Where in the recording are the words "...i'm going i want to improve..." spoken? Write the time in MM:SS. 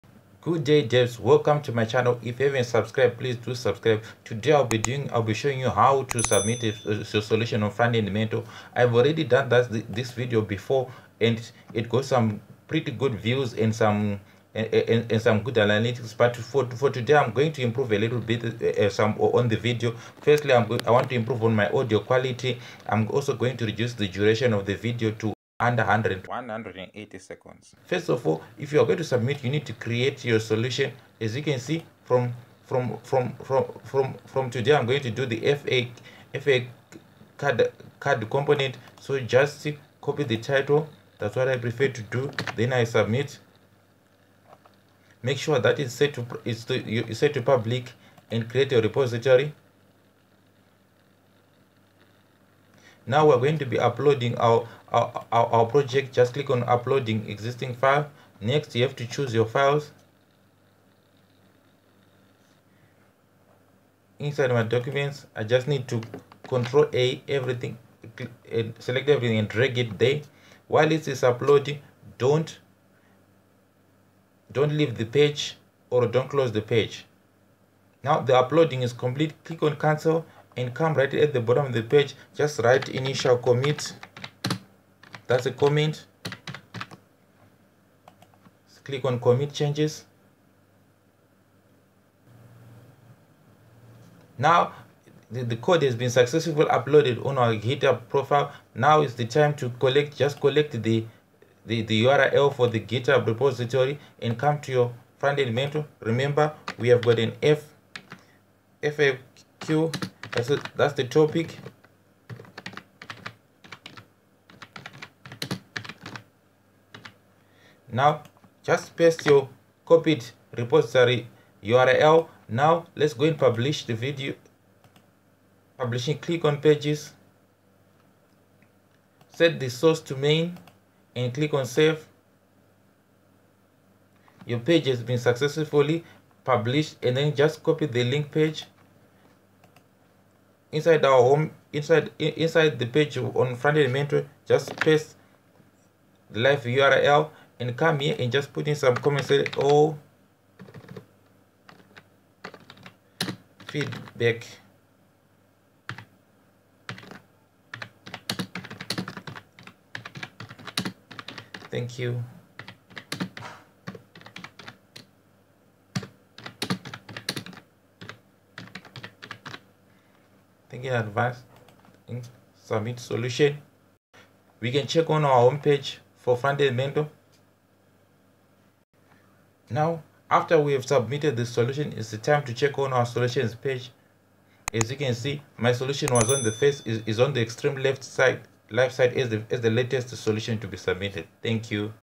00:20.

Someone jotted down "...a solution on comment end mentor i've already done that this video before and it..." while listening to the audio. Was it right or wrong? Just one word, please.
wrong.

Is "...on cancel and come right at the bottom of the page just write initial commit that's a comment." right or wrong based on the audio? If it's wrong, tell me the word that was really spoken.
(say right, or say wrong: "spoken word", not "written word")
right.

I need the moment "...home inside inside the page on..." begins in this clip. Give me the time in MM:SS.
02:21.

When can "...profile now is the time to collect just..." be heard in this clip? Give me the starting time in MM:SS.
01:38.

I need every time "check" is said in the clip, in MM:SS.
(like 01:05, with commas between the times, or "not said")
02:54, 03:02.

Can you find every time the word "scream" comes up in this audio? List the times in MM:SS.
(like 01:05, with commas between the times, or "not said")
not said.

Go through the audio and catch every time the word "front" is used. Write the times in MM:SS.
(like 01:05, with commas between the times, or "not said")
00:07, 01:45, 02:23, 02:56.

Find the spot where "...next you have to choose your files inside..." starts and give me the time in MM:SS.
00:58.